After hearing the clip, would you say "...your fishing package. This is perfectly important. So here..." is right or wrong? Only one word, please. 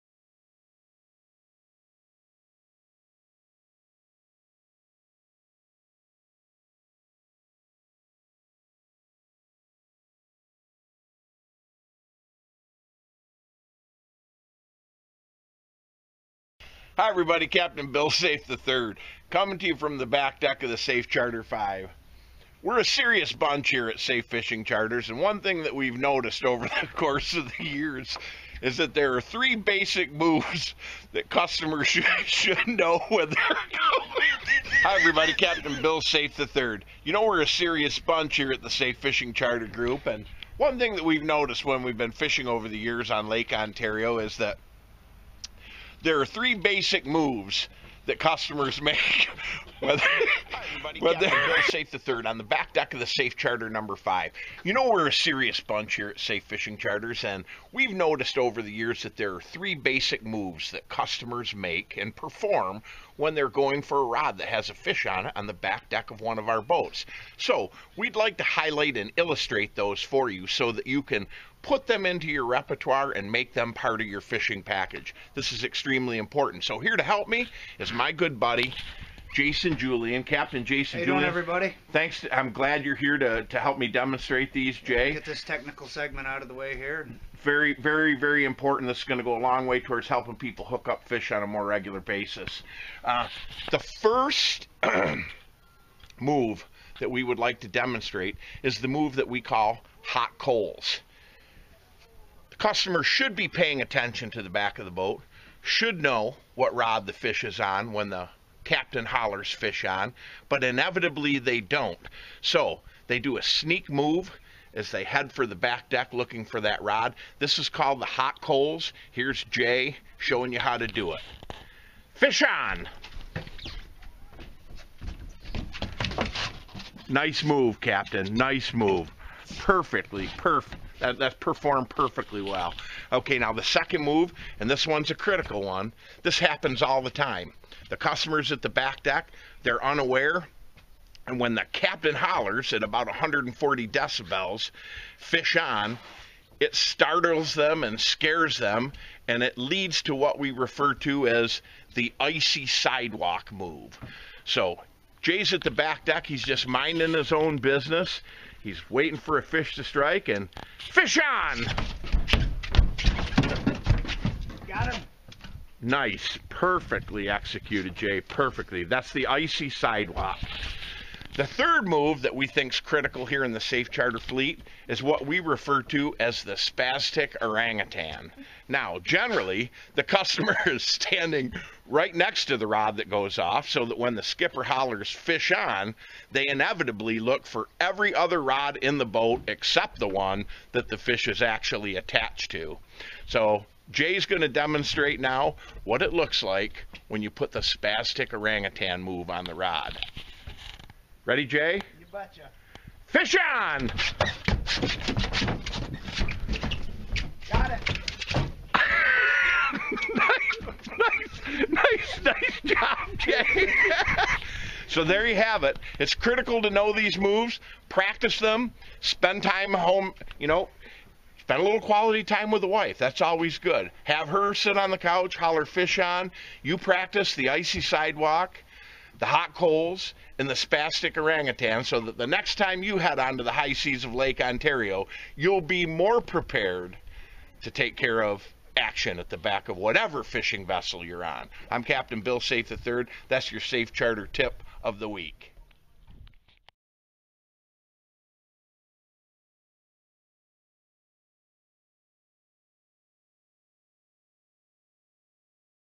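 wrong.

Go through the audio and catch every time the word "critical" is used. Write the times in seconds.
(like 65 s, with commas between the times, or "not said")
135 s, 172 s, 216 s.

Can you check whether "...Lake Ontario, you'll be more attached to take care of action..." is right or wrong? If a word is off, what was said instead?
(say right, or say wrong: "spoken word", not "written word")
wrong: "prepared", not "attached".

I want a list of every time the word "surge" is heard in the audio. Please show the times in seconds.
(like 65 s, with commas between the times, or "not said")
not said.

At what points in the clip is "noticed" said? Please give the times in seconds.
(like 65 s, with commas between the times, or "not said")
25 s, 41 s, 57 s.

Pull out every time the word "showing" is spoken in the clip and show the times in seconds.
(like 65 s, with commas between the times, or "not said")
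120 s.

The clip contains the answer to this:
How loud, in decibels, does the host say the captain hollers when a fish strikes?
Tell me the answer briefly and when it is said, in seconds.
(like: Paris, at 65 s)
140, at 143 s.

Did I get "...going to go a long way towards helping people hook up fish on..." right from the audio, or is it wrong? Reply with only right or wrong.
right.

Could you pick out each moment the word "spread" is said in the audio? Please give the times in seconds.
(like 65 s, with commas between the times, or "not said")
not said.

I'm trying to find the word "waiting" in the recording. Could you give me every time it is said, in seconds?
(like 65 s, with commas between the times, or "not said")
158 s.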